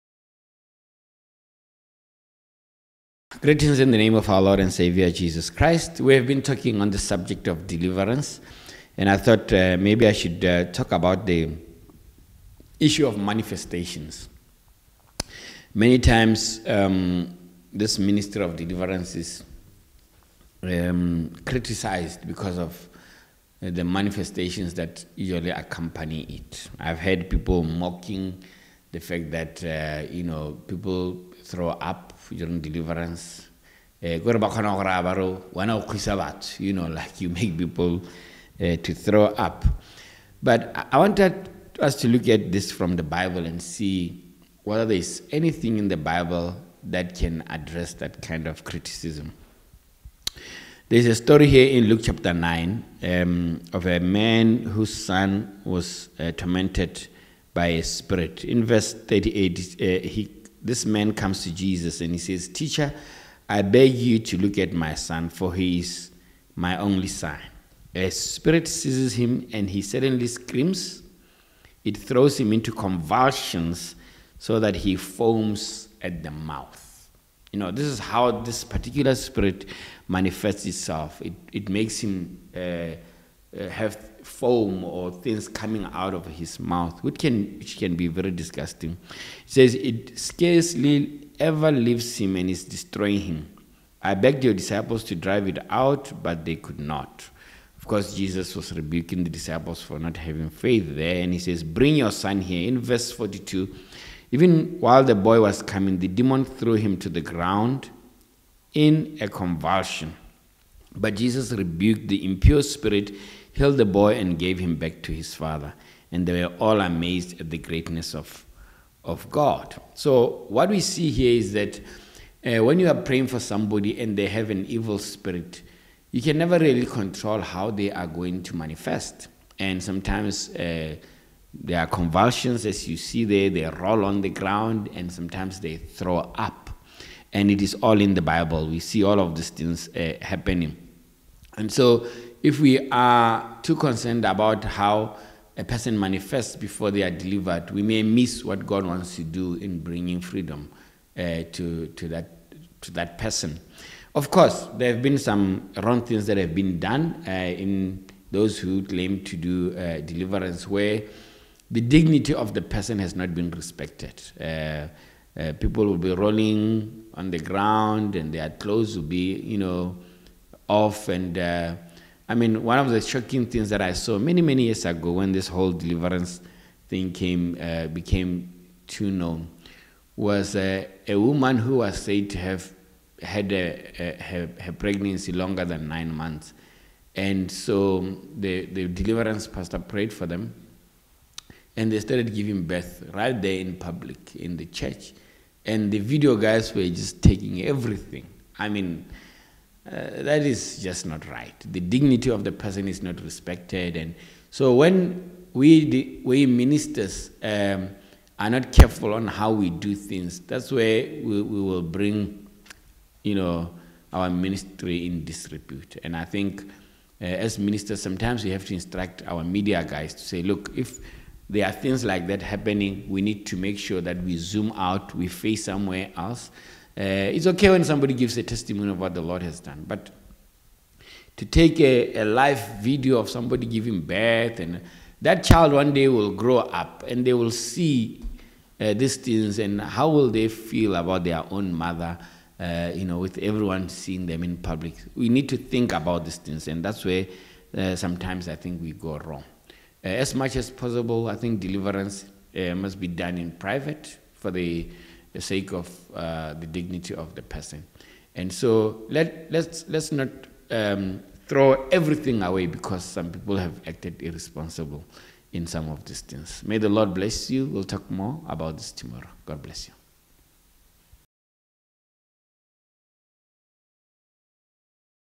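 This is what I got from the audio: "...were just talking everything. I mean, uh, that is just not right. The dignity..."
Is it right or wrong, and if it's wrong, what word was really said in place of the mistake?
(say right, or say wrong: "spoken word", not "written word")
wrong: "taking", not "talking".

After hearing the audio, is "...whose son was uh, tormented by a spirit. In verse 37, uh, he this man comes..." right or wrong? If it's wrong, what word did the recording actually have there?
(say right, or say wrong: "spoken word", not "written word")
wrong: "38", not "37".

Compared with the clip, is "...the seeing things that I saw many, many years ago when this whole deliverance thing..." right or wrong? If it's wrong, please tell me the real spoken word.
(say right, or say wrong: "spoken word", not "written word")
wrong: "shocking", not "seeing".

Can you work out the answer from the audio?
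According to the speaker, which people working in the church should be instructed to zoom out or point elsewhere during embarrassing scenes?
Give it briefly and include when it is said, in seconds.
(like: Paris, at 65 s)
media guys, at 219 s.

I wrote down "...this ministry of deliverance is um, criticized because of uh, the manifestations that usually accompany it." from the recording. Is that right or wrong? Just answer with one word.
right.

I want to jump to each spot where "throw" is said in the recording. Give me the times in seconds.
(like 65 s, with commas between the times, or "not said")
31 s, 38 s, 71 s, 135 s, 261 s.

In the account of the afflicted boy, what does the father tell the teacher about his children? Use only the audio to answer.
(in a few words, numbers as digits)
only son.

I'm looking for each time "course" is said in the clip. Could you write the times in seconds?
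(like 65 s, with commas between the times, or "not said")
97 s, 154 s.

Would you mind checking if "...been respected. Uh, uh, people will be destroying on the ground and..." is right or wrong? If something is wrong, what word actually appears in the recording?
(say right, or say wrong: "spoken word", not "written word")
wrong: "rolling", not "destroying".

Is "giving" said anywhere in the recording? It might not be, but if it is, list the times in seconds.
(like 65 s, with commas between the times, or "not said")
192 s, 233 s.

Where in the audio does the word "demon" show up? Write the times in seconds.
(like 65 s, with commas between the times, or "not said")
106 s.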